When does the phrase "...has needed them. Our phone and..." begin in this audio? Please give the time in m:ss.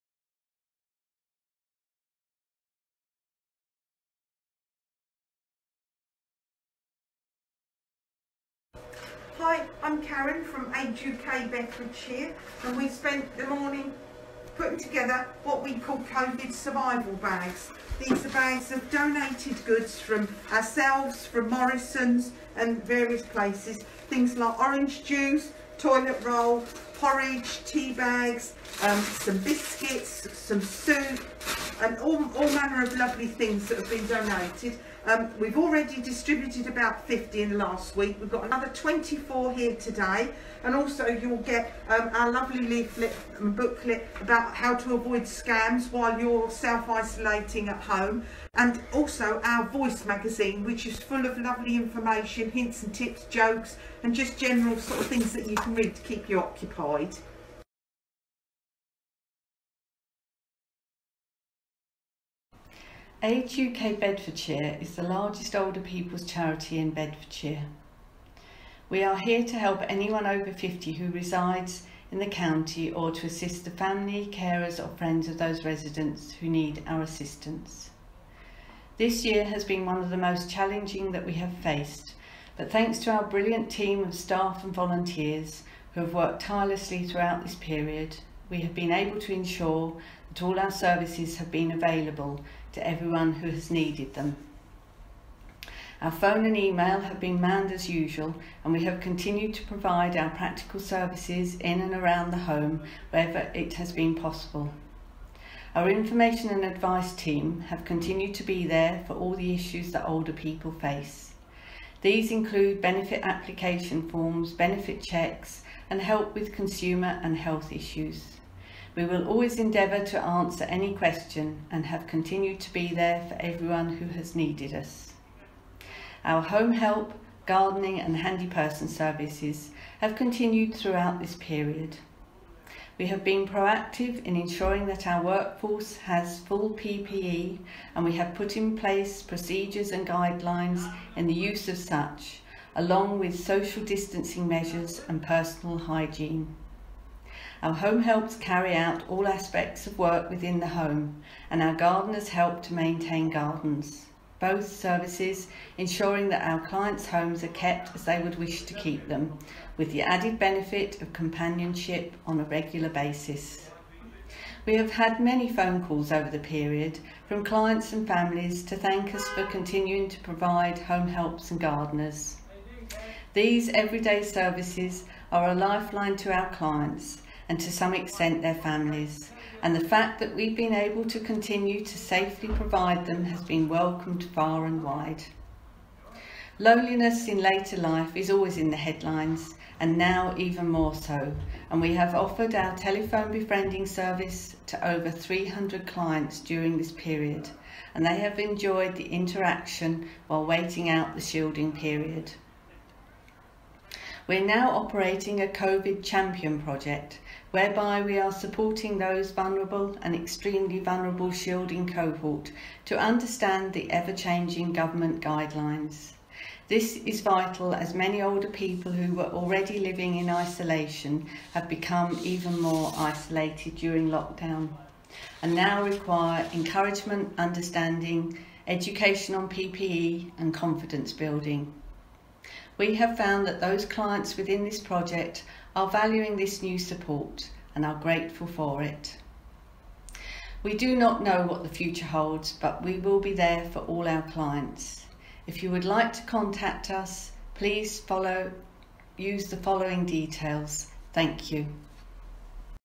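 1:33.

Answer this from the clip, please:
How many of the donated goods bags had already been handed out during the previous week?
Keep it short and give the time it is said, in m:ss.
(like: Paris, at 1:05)
50, at 0:36.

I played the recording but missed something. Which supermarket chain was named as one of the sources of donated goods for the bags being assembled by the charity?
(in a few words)
Morrison's.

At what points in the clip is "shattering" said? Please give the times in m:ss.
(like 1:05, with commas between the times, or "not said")
not said.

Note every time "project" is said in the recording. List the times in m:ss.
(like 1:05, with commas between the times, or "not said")
3:26, 3:54.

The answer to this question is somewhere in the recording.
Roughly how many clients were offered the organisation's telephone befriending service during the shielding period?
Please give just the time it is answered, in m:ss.
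3:14.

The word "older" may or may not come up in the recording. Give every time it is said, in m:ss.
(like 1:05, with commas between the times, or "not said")
1:05, 1:50, 3:38.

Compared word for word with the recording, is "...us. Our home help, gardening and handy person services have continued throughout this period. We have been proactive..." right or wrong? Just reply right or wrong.
right.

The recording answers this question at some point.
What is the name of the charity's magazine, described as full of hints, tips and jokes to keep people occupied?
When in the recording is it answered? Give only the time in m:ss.
0:49.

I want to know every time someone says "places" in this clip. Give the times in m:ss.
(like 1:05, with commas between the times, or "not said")
0:23, 2:18.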